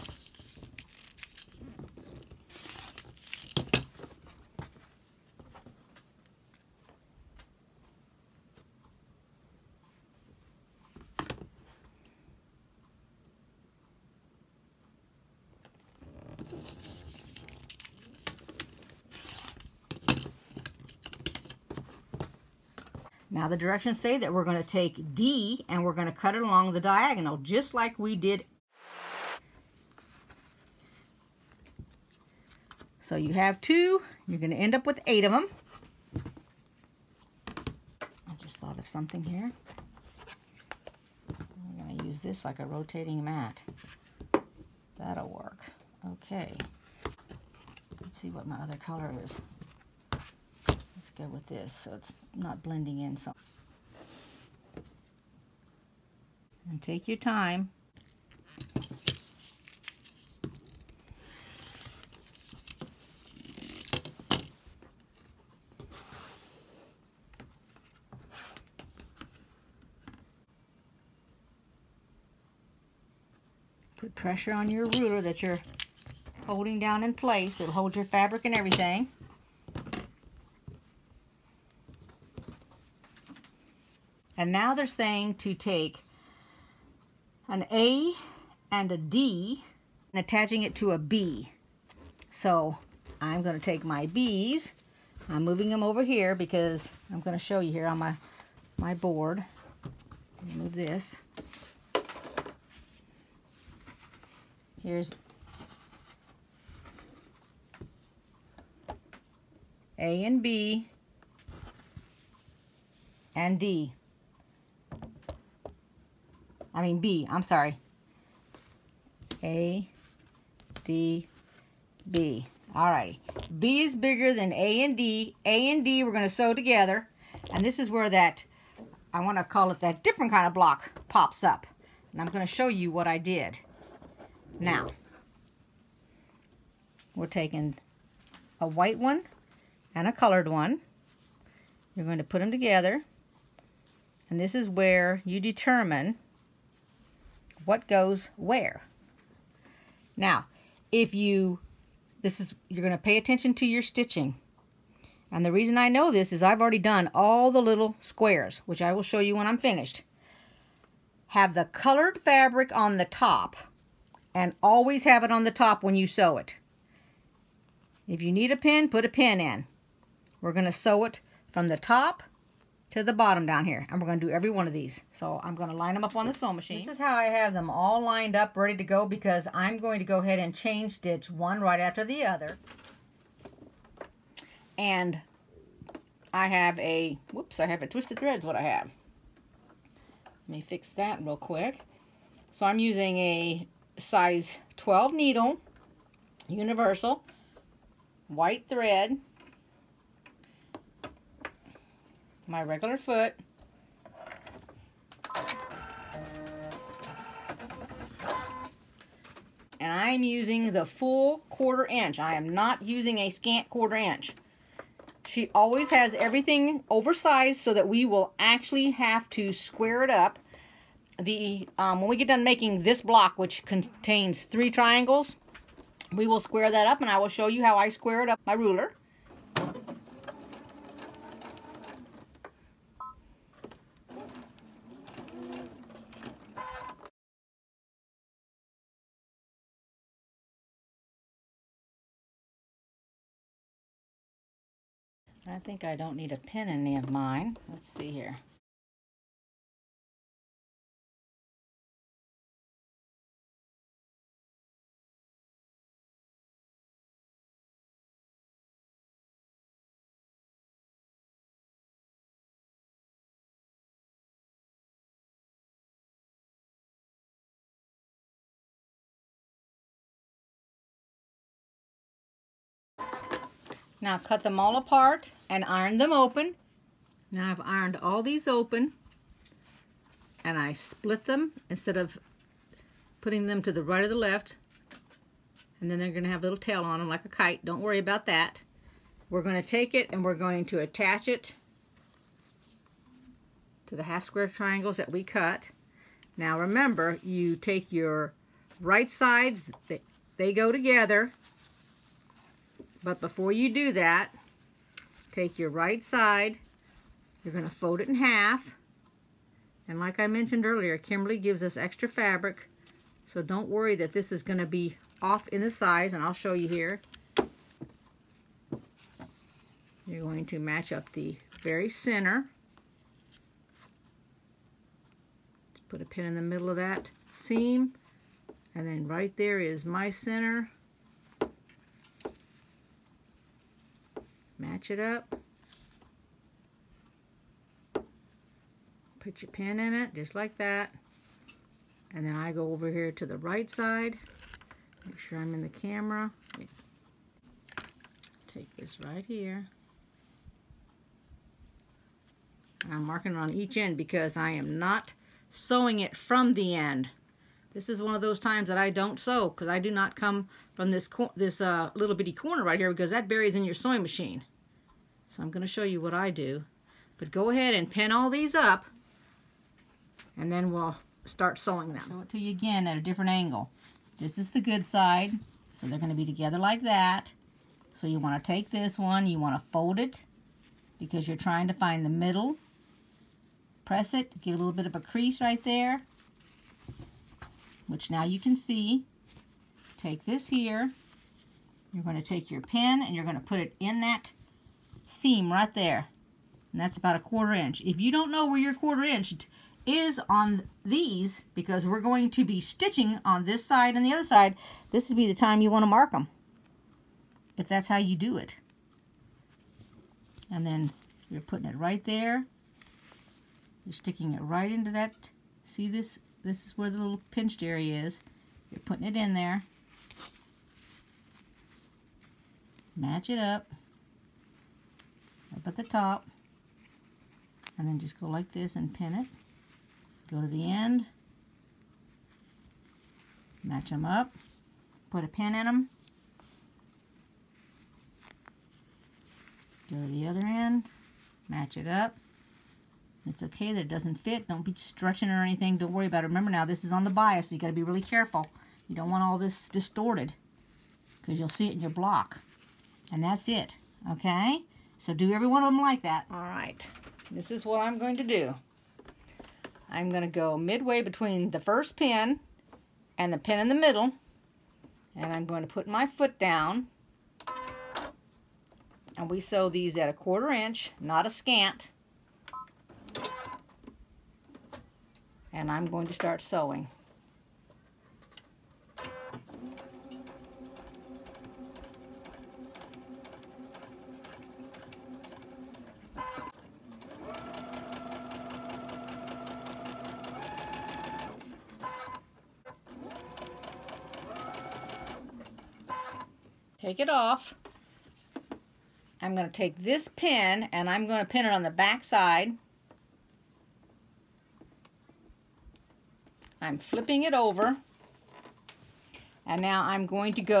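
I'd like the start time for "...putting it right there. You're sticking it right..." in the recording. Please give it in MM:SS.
06:51.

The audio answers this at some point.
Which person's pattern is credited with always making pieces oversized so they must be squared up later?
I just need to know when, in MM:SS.
05:10.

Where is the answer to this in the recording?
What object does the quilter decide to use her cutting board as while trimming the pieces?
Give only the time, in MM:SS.
00:42.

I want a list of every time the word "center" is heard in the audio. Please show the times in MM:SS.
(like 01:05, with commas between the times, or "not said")
05:21, 05:30.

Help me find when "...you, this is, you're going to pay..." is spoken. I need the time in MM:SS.
02:31.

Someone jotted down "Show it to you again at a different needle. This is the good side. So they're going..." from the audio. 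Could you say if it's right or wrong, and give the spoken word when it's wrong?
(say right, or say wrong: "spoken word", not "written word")
wrong: "angle", not "needle".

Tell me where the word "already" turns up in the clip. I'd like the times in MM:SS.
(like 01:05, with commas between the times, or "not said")
02:36.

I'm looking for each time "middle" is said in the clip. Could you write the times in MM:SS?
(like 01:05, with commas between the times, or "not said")
05:26, 06:22, 07:43.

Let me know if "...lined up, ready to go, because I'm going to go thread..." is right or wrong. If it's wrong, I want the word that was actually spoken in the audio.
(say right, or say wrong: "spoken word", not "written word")
wrong: "ahead", not "thread".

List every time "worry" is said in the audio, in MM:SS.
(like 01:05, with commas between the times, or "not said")
04:47, 05:13, 07:25.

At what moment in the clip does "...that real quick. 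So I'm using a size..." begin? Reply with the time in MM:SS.
03:10.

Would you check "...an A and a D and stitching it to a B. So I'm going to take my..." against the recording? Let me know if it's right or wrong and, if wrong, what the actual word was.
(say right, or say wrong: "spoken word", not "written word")
wrong: "attaching", not "stitching".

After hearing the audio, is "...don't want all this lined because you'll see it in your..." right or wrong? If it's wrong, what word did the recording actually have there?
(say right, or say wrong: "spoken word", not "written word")
wrong: "distorted", not "lined".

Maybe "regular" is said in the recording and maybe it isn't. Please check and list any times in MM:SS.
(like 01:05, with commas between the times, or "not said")
03:22.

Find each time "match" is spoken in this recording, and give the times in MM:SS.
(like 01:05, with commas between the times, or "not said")
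05:20, 05:34, 07:02, 07:13, 07:21.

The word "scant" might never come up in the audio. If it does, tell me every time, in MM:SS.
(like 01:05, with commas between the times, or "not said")
03:33, 07:51.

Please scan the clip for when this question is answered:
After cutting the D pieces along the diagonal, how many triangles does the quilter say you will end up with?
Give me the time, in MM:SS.
00:35.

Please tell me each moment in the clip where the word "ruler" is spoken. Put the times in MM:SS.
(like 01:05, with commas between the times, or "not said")
01:14, 03:48.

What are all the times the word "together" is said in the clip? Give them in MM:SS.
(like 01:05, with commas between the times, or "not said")
02:06, 02:22, 05:00, 06:16.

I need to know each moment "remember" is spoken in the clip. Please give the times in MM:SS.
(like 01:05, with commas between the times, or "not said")
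04:56, 07:26.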